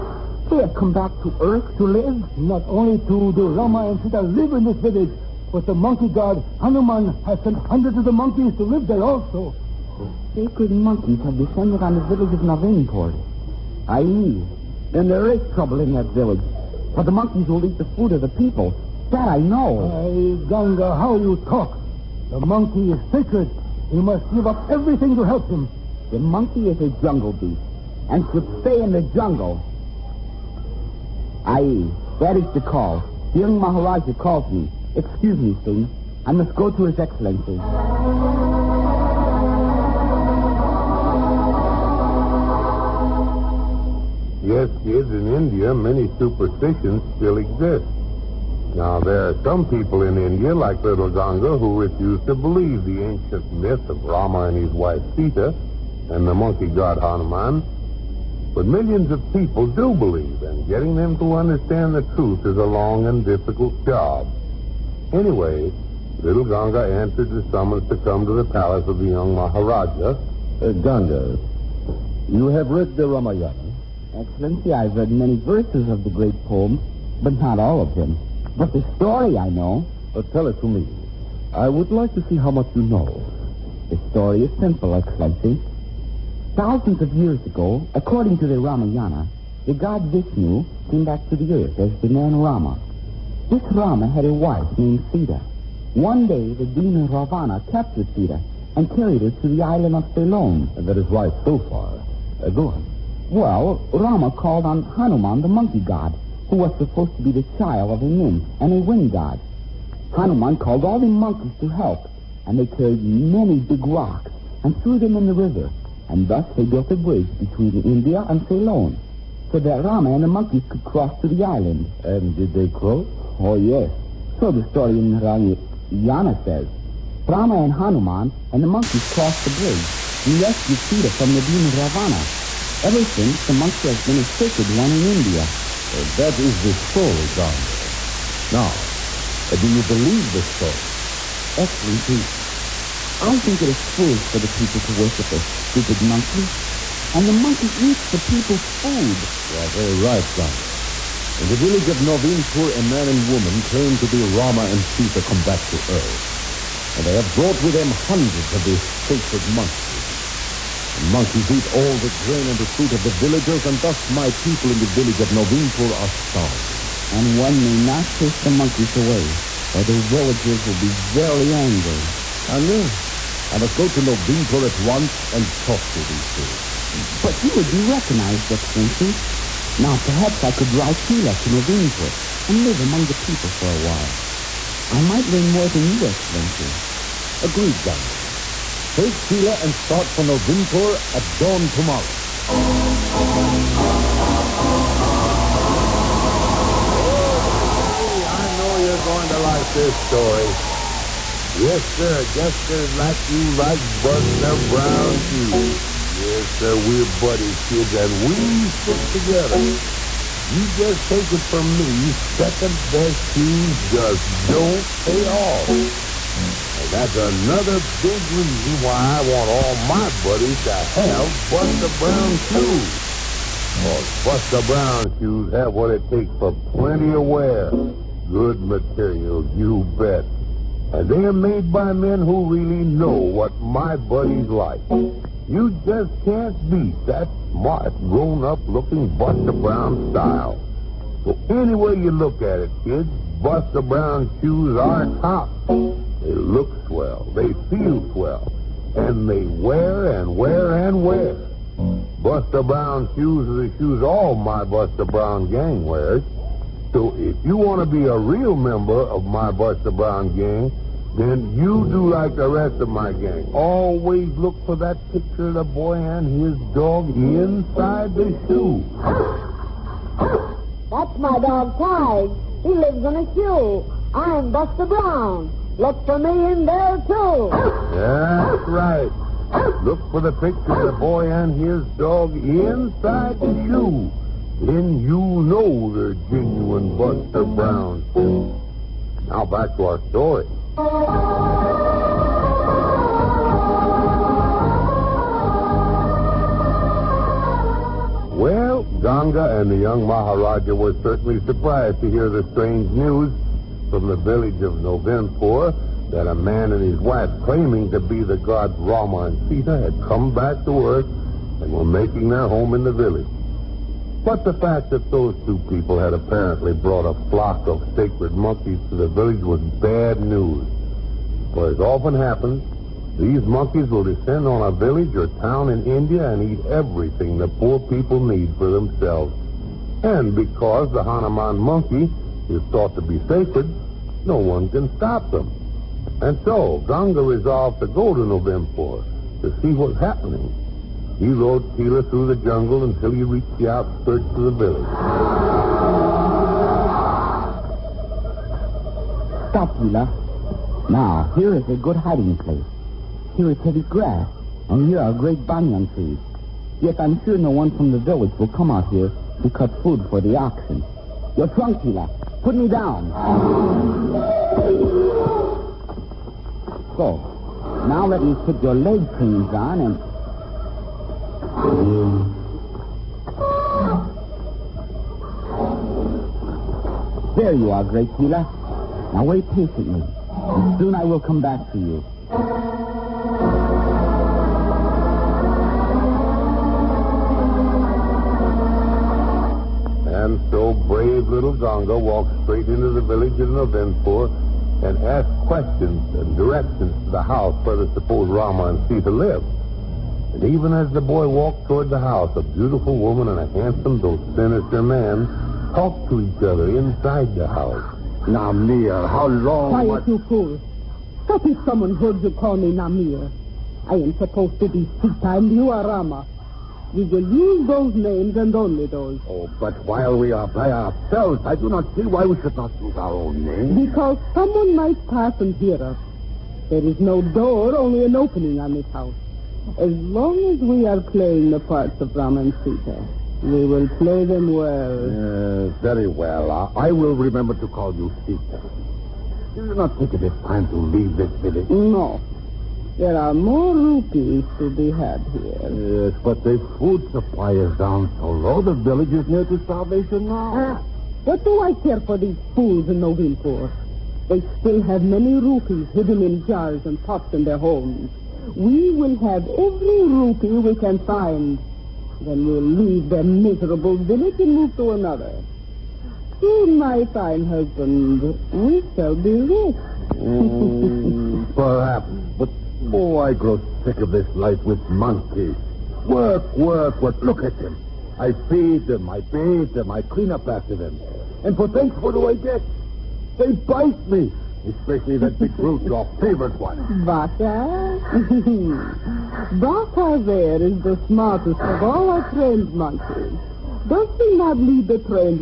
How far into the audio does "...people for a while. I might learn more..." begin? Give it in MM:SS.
03:03.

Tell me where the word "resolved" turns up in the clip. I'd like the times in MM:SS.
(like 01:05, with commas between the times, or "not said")
05:37.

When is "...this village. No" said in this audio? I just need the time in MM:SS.
07:21.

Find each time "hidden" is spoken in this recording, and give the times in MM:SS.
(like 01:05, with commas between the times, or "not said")
07:35.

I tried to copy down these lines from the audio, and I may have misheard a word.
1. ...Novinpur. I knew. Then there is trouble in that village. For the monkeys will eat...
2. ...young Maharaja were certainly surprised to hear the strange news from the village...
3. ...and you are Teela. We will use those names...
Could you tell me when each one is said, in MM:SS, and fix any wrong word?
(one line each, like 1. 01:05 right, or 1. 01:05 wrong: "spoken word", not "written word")
1. 00:12 right
2. 04:59 right
3. 06:55 wrong: "Rama", not "Teela".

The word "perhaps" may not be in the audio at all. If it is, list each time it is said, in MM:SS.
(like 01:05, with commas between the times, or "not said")
02:59, 07:51.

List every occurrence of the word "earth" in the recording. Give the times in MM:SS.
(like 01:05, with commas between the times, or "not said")
00:01, 01:31, 02:35, 05:10.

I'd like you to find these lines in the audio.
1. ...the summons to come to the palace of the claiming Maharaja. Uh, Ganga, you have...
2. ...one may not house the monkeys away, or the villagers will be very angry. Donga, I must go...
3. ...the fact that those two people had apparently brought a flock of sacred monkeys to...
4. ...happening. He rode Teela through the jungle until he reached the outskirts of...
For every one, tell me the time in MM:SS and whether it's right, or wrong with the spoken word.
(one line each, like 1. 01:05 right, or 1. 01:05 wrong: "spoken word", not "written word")
1. 01:07 wrong: "young", not "claiming"
2. 02:47 wrong: "chase", not "house"
3. 05:14 right
4. 05:39 right.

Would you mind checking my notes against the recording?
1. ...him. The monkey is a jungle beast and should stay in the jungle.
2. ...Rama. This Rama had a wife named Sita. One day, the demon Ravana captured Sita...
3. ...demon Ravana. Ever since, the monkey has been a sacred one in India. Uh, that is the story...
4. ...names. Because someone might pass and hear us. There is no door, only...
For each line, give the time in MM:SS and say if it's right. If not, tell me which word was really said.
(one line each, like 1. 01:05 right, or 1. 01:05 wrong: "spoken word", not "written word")
1. 00:25 right
2. 01:32 right
3. 02:11 right
4. 07:03 right.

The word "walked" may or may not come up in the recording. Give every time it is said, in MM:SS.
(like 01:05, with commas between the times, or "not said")
06:31, 06:41.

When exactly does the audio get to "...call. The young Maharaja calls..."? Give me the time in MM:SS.
00:32.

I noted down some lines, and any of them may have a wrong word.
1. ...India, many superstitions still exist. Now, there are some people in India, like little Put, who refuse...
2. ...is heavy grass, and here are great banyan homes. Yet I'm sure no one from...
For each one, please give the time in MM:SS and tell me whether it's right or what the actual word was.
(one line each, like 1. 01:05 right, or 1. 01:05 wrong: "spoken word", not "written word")
1. 00:45 wrong: "Ganga", not "Put"
2. 05:53 wrong: "trees", not "homes".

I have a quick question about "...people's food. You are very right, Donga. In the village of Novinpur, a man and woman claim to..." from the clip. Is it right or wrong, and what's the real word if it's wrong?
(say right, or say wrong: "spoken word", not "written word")
right.